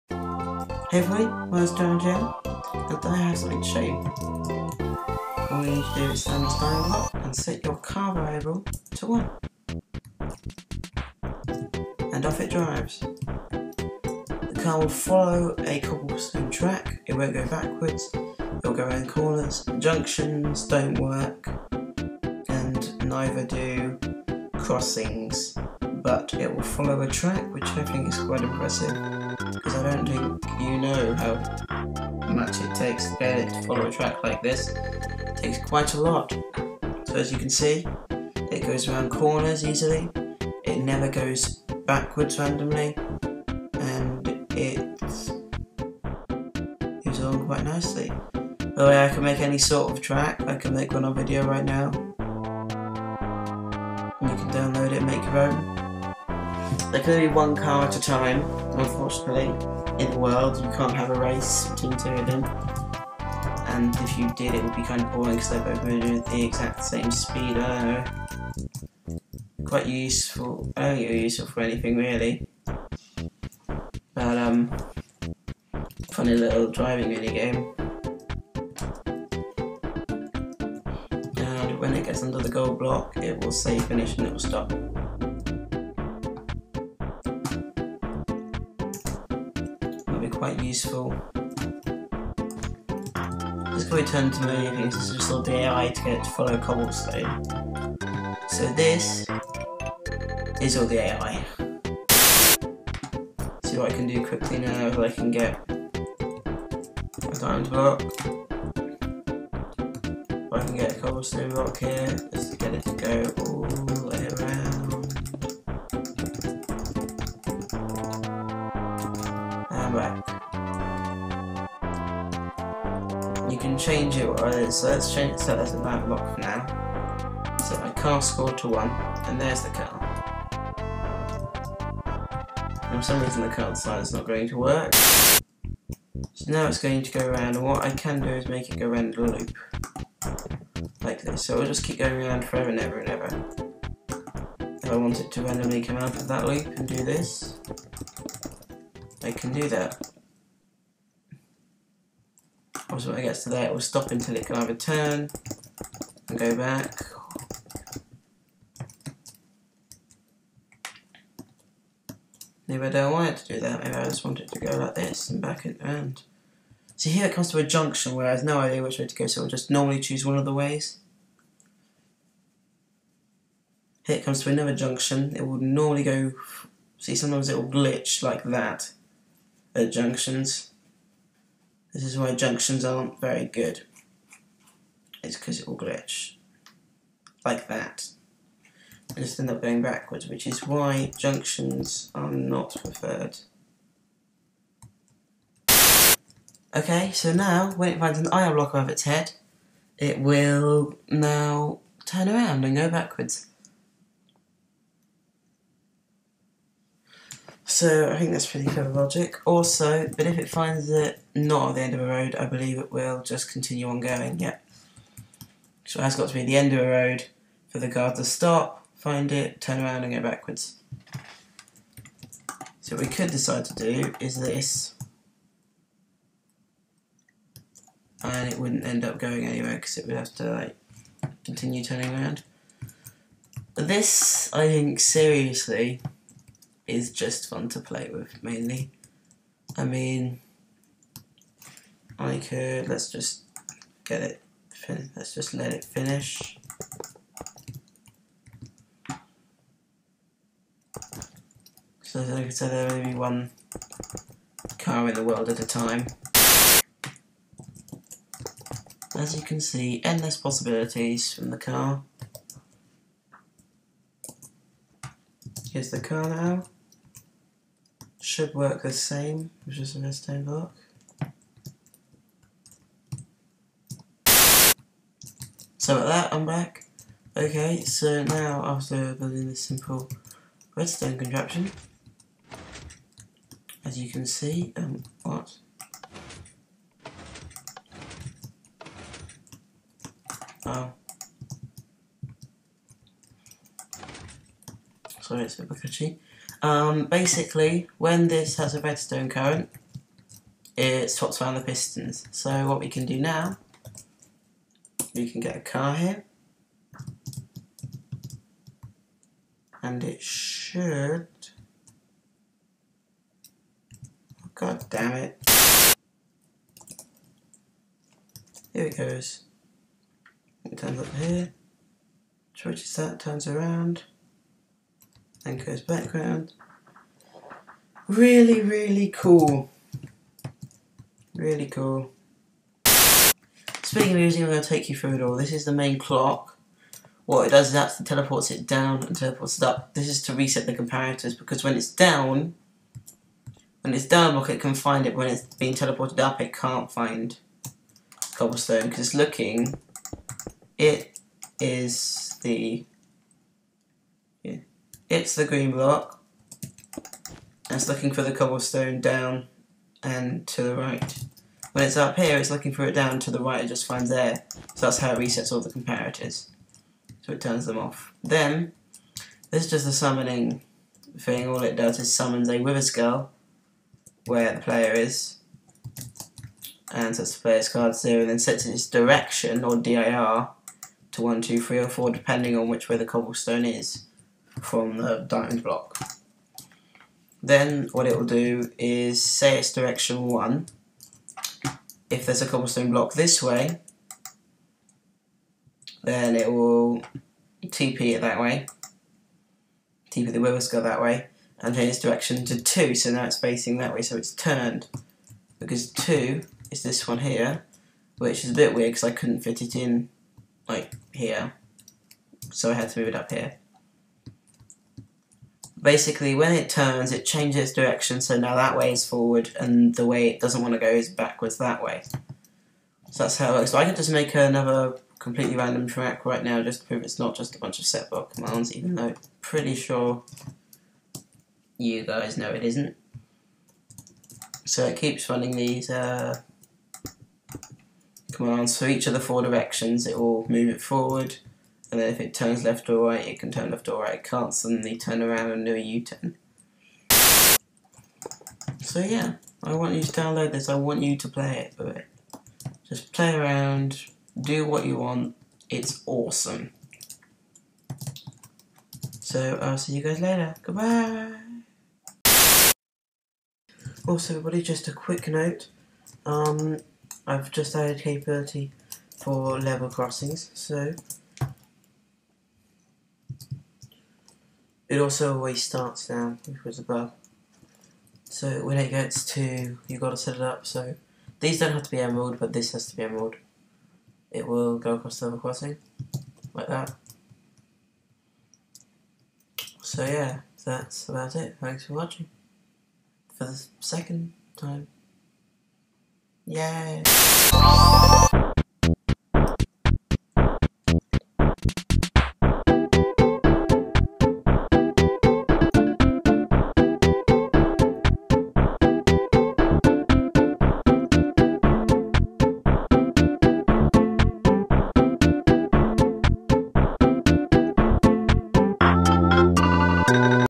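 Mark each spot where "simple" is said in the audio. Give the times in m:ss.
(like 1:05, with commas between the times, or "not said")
4:39.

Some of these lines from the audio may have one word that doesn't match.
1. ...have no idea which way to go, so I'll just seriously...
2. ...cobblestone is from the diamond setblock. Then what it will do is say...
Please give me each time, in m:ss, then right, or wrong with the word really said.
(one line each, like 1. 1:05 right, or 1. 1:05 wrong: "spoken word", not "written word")
1. 2:48 wrong: "normally", not "seriously"
2. 6:23 wrong: "block", not "setblock".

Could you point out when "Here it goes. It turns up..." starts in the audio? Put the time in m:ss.
5:18.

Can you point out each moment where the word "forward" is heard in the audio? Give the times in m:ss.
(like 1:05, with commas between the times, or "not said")
6:59, 7:20.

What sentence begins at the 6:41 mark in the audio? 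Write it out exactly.
And change its direction to 2, so now it's facing that way, so it's turned.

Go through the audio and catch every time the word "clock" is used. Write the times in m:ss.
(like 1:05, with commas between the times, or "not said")
5:35.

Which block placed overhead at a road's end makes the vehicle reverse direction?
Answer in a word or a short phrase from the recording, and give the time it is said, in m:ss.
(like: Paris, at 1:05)
iron block, at 3:18.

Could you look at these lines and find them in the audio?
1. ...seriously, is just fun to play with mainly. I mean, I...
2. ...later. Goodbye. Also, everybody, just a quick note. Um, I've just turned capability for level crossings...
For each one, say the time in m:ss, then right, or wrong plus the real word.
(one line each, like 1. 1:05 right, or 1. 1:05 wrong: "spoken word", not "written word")
1. 3:54 right
2. 7:40 wrong: "added", not "turned".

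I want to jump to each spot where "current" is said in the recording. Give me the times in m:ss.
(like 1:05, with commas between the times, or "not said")
4:59.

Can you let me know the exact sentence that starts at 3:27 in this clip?
So I think that's pretty clever logic.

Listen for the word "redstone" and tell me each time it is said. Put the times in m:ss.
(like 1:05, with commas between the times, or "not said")
4:29, 4:40, 4:58.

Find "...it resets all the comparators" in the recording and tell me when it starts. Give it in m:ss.
6:05.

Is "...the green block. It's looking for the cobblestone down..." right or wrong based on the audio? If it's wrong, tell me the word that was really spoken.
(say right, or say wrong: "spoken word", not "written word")
right.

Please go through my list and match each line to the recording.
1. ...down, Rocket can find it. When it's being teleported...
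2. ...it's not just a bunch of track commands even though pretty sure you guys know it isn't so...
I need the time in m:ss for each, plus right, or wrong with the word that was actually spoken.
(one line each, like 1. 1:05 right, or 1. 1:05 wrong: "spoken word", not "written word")
1. 5:44 right
2. 7:07 wrong: "setblock", not "track".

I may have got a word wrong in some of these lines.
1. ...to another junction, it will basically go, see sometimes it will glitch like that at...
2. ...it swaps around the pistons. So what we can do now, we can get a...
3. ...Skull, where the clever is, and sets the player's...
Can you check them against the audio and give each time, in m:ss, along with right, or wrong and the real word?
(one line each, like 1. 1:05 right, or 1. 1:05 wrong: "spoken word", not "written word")
1. 2:54 wrong: "normally", not "basically"
2. 5:00 right
3. 6:12 wrong: "player", not "clever".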